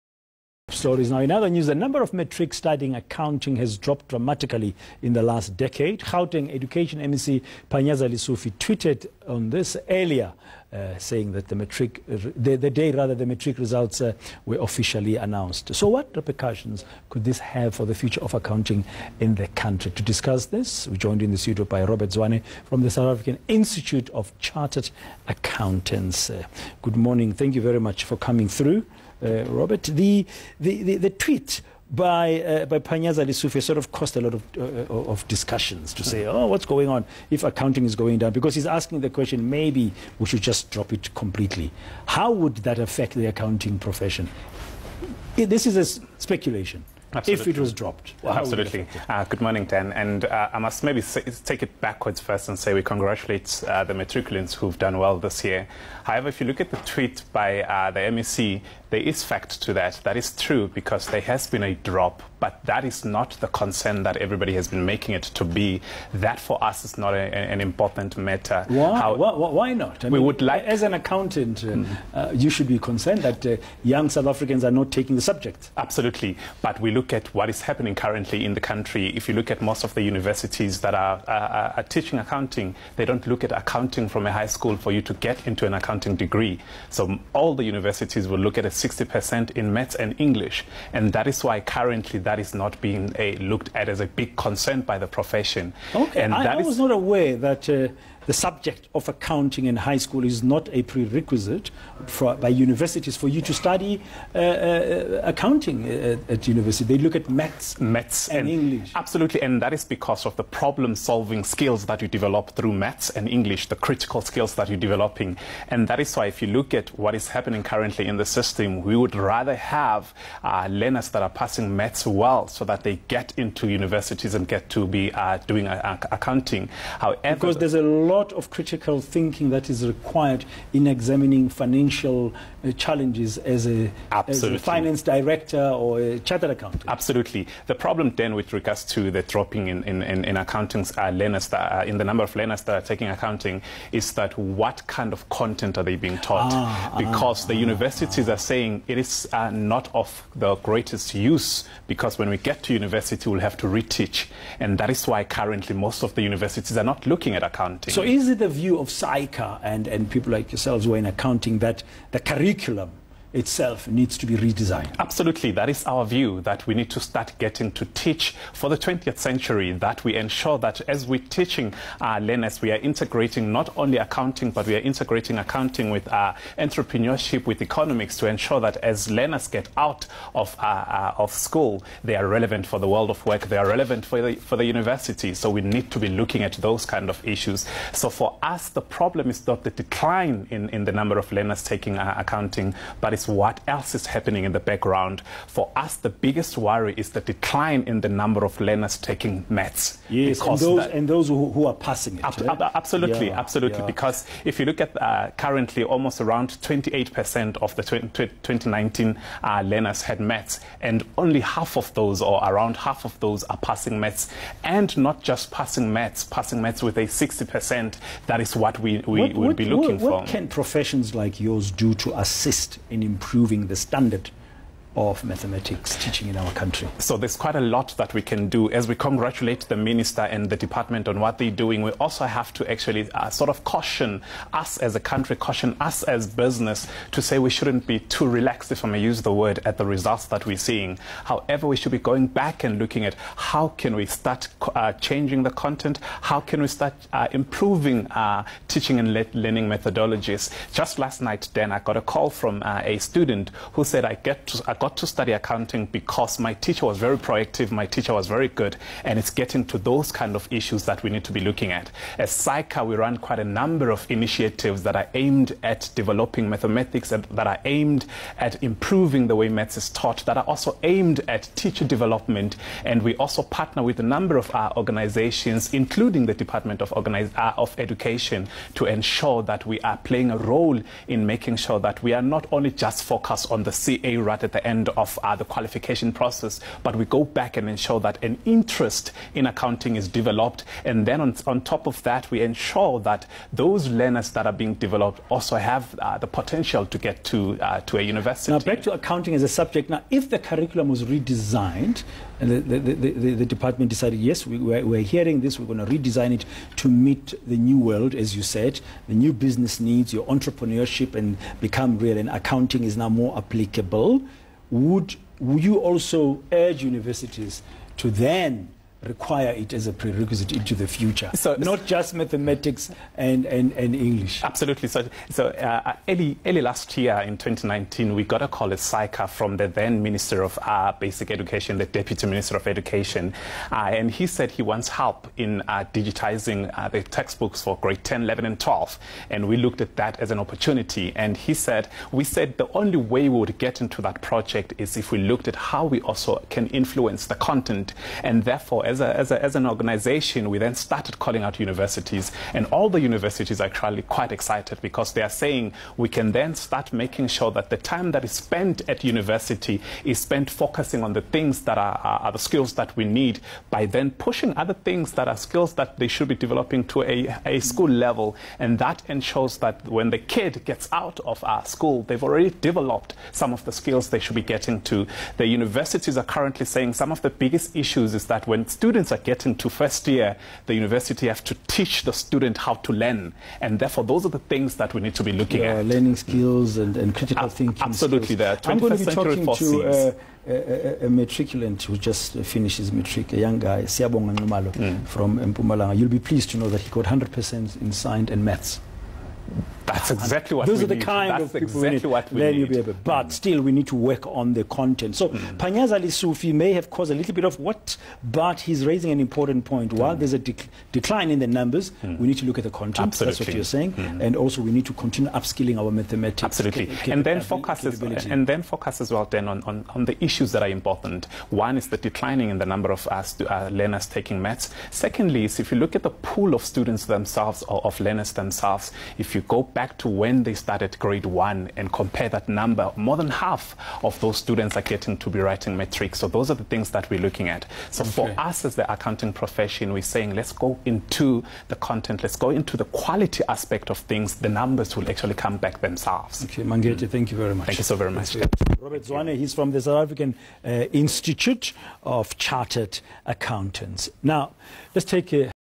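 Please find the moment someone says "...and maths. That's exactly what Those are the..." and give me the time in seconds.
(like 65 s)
398 s.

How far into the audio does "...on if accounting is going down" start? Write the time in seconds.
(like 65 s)
36 s.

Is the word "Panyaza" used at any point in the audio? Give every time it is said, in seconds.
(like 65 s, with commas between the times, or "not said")
7 s, 32 s.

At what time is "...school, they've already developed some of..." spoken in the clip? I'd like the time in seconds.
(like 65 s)
371 s.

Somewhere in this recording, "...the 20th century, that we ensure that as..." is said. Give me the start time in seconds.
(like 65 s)
168 s.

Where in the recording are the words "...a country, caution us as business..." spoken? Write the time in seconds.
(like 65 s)
234 s.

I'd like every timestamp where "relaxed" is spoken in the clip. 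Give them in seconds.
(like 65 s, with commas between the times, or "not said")
238 s.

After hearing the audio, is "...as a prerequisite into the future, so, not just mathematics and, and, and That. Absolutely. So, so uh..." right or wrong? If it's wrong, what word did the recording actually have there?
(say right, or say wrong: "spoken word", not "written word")
wrong: "English", not "That".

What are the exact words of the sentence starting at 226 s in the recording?
So there's quite a lot that we can do.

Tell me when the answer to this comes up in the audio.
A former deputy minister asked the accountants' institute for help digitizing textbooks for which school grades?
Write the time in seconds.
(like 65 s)
337 s.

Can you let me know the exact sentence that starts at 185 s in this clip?
So we need to be looking at those kind of issues.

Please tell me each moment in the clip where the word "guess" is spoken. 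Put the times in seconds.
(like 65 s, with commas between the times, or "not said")
not said.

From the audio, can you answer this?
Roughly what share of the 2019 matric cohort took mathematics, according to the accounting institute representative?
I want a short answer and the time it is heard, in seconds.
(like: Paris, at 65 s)
28%, at 206 s.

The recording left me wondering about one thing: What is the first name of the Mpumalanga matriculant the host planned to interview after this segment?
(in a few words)
Siyabonga.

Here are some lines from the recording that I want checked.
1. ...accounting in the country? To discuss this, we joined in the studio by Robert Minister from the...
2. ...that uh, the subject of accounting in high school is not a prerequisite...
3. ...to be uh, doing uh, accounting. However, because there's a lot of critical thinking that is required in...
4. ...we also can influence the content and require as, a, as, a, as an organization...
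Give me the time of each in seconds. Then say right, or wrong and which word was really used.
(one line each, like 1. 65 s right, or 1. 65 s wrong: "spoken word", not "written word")
1. 18 s wrong: "Zwane", not "Minister"
2. 97 s right
3. 124 s right
4. 345 s wrong: "therefore", not "require".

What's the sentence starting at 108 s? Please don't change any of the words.
Absolutely, and that is because of the problem-solving skills that you develop through maths and English, the critical skills that you're developing.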